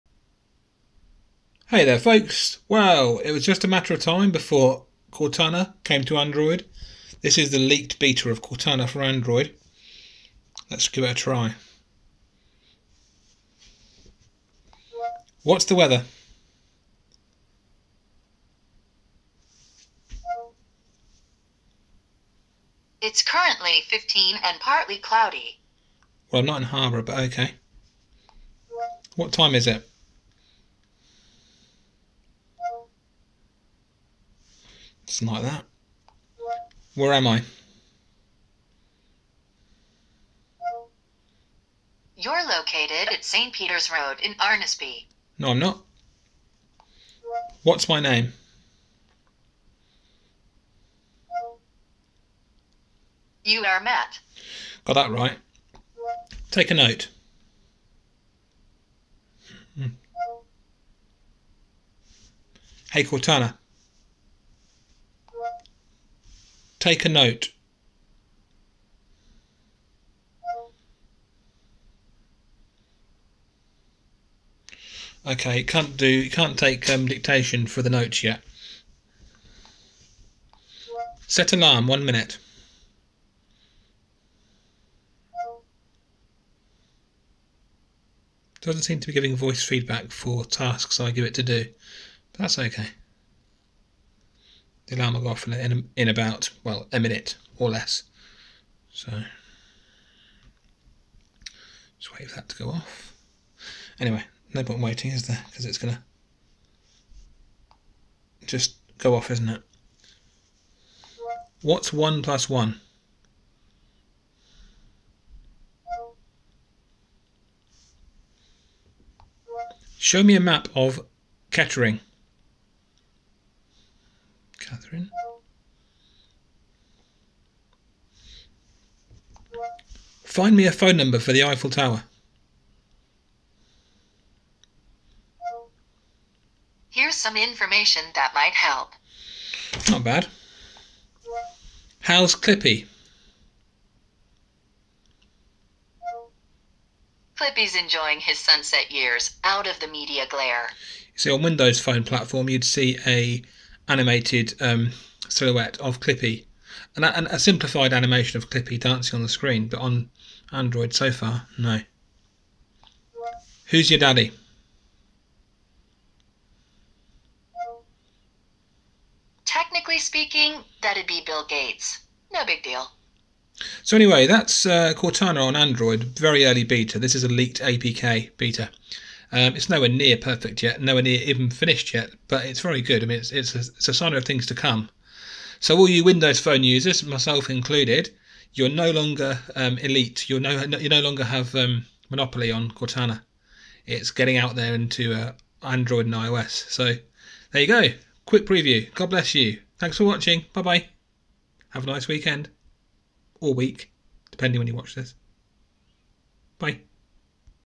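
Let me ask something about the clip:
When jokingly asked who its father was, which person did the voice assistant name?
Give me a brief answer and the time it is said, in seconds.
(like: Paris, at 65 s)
Bill Gates, at 171 s.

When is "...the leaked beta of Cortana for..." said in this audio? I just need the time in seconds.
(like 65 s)
7 s.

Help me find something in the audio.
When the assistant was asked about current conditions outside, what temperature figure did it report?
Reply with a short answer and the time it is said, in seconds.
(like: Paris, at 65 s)
15, at 23 s.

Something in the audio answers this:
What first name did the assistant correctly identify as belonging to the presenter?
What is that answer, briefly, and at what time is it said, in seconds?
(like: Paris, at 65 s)
Matt, at 53 s.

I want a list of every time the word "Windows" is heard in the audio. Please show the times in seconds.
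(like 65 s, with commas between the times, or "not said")
151 s, 186 s.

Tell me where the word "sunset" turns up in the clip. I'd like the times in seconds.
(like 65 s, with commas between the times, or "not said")
148 s.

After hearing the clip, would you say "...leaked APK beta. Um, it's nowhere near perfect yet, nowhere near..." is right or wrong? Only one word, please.
right.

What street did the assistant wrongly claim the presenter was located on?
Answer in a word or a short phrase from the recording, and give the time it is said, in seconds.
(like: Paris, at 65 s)
St. Peter's Road, at 43 s.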